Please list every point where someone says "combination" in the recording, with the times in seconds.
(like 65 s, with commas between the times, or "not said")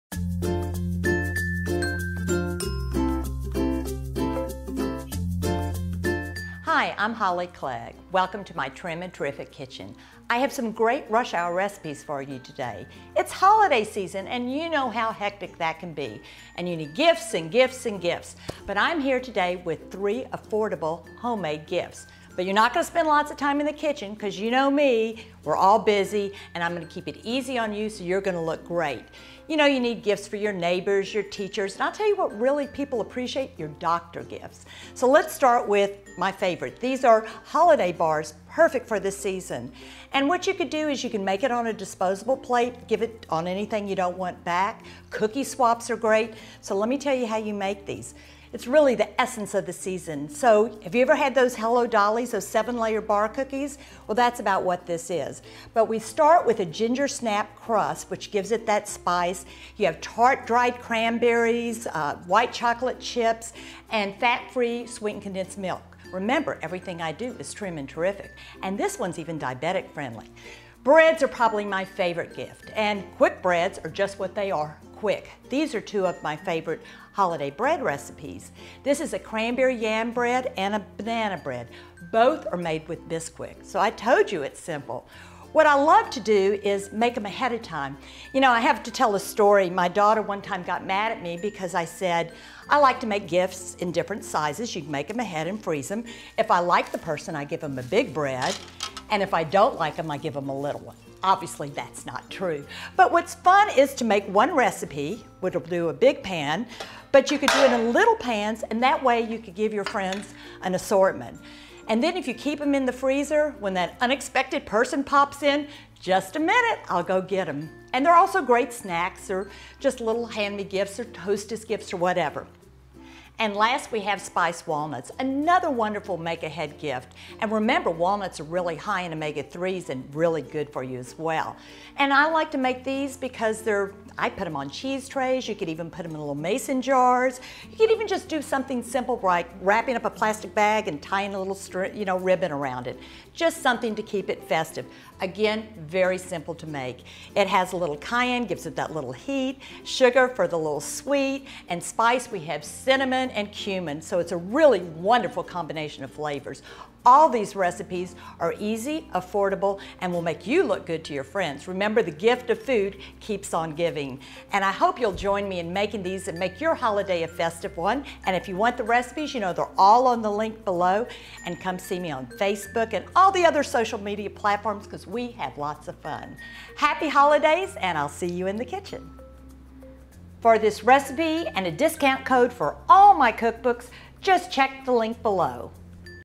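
155 s.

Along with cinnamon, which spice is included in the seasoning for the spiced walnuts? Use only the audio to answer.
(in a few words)
Cumin.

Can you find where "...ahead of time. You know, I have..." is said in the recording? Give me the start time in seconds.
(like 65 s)
87 s.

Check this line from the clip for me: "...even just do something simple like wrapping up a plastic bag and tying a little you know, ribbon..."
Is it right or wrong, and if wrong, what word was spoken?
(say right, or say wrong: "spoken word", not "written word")
right.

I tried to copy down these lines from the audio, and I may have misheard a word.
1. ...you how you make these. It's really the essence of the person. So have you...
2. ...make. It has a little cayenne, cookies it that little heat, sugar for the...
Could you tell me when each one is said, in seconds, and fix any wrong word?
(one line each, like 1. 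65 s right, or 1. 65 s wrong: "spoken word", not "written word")
1. 47 s wrong: "season", not "person"
2. 146 s wrong: "gives", not "cookies".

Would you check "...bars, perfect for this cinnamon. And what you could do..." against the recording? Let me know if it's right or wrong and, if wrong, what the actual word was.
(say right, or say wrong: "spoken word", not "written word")
wrong: "season", not "cinnamon".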